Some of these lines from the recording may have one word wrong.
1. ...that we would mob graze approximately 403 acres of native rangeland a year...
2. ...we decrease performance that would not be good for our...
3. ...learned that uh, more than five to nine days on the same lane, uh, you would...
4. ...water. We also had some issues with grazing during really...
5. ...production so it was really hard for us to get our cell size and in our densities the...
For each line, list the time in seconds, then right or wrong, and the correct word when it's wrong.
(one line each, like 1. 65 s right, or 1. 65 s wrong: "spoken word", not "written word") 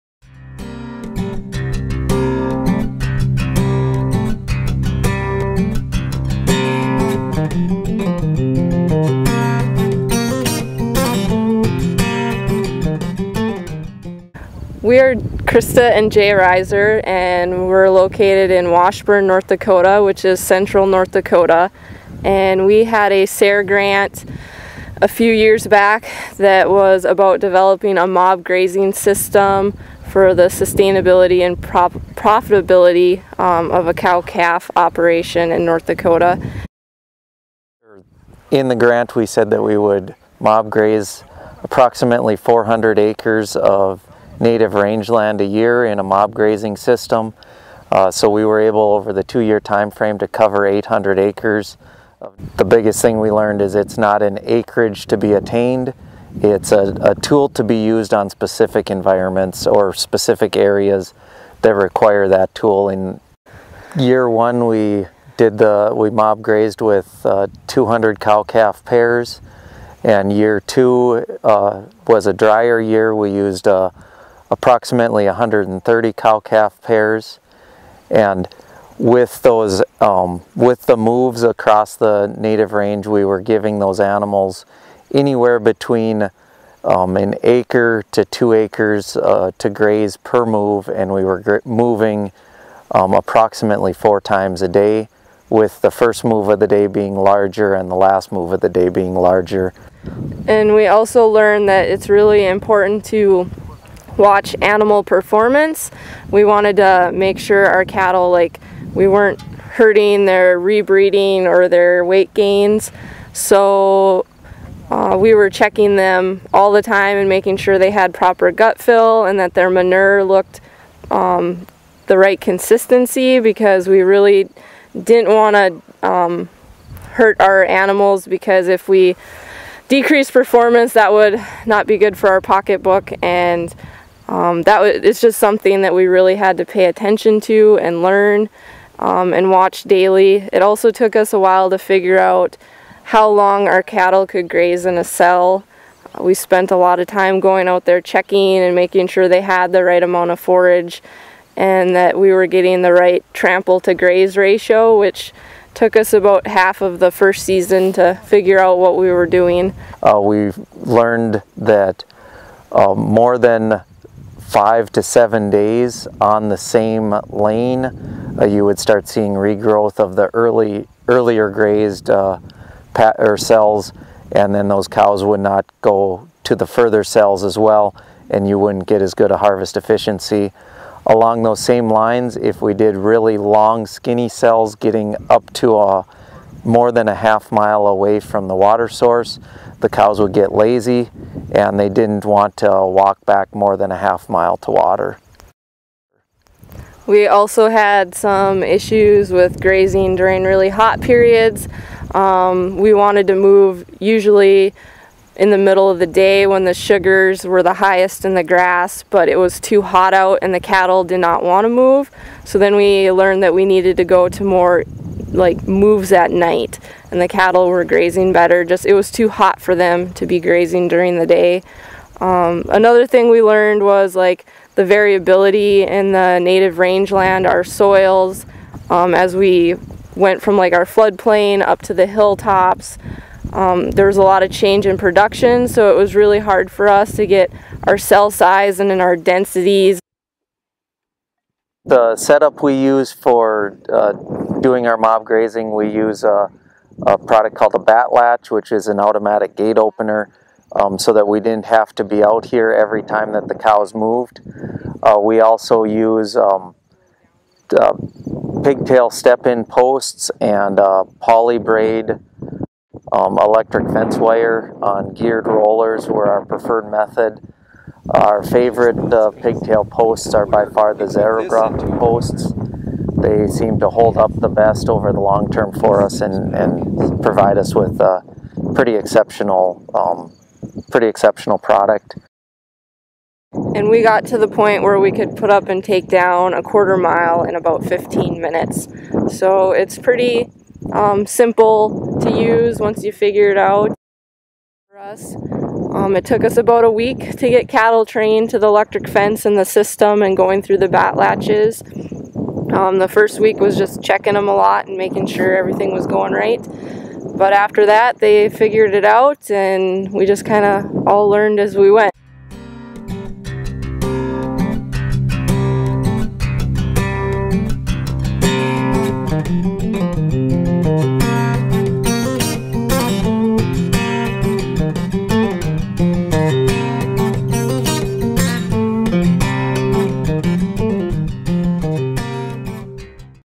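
1. 39 s wrong: "400", not "403"
2. 128 s right
3. 160 s wrong: "seven", not "nine"
4. 194 s right
5. 234 s right.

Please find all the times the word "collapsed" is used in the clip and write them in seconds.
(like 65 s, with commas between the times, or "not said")
not said.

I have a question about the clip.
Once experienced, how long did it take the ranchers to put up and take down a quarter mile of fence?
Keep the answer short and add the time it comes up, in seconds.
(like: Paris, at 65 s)
15 minutes, at 287 s.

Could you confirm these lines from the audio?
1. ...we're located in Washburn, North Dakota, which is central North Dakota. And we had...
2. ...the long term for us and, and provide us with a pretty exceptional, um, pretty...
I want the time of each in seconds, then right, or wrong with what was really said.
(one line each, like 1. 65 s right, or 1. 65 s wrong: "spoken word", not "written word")
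1. 17 s right
2. 275 s right.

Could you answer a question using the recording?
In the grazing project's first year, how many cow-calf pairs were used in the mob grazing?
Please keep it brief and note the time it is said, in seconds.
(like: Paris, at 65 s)
200, at 67 s.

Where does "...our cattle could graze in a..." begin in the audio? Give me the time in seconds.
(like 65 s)
143 s.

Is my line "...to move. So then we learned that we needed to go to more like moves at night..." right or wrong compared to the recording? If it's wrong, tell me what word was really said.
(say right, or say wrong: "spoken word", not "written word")
right.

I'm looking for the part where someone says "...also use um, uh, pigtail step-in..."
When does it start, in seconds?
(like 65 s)
255 s.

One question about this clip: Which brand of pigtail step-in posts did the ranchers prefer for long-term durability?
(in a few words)
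Zerograph.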